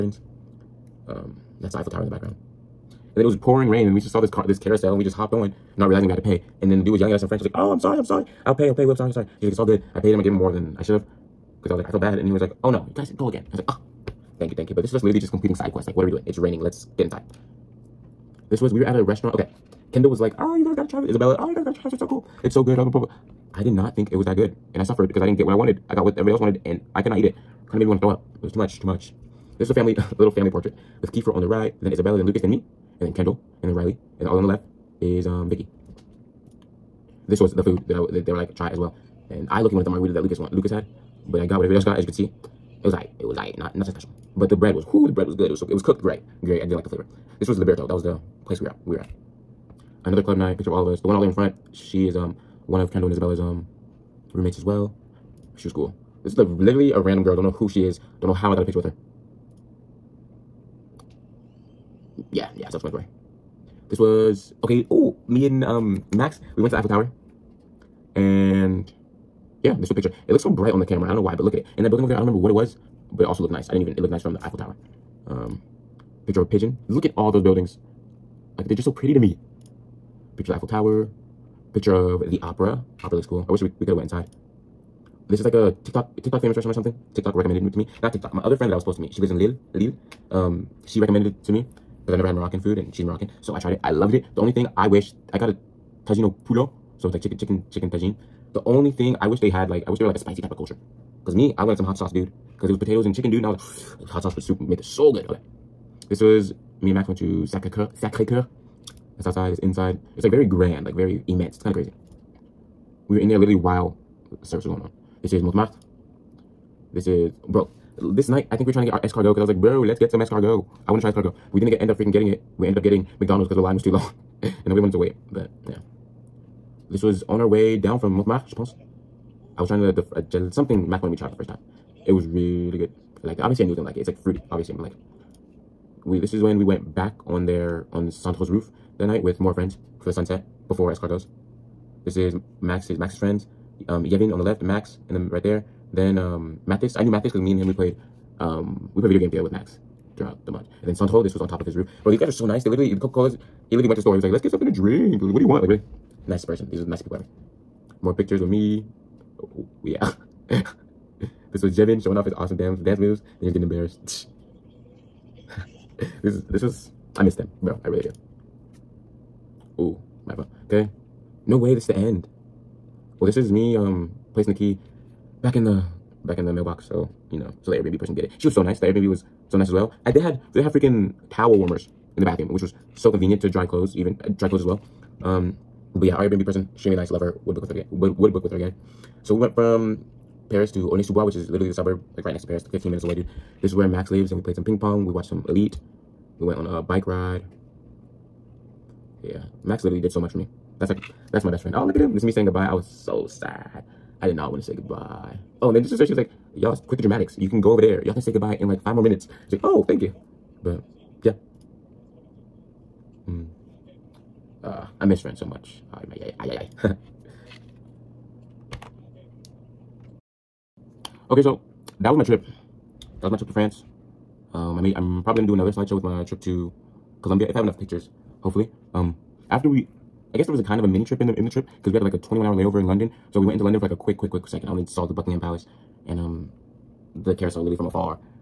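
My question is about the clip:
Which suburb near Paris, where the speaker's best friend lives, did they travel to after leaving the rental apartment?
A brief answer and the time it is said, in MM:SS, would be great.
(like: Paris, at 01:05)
Aulnay-sous-Bois, at 03:10.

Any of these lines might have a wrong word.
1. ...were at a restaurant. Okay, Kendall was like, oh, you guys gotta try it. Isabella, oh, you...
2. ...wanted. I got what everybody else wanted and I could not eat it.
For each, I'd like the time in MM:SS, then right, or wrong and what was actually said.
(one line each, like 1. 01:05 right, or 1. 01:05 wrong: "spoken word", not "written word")
1. 00:18 right
2. 00:25 right.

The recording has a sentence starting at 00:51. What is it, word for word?
She is um one of Kendall and Isabella's um roommates as well.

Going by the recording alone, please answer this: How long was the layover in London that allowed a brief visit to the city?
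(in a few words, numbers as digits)
21 hours.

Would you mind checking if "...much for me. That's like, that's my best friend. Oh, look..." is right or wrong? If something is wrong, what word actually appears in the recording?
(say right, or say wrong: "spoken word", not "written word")
right.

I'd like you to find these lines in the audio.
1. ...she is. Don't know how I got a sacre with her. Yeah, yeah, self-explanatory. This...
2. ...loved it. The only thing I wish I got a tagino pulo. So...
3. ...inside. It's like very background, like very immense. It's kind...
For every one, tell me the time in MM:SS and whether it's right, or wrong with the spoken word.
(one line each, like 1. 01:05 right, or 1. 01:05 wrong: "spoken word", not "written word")
1. 00:57 wrong: "picture", not "sacre"
2. 01:33 right
3. 01:49 wrong: "grand", not "background".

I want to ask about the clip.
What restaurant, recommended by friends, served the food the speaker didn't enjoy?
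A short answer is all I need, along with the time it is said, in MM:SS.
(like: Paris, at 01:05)
Liberto, at 00:47.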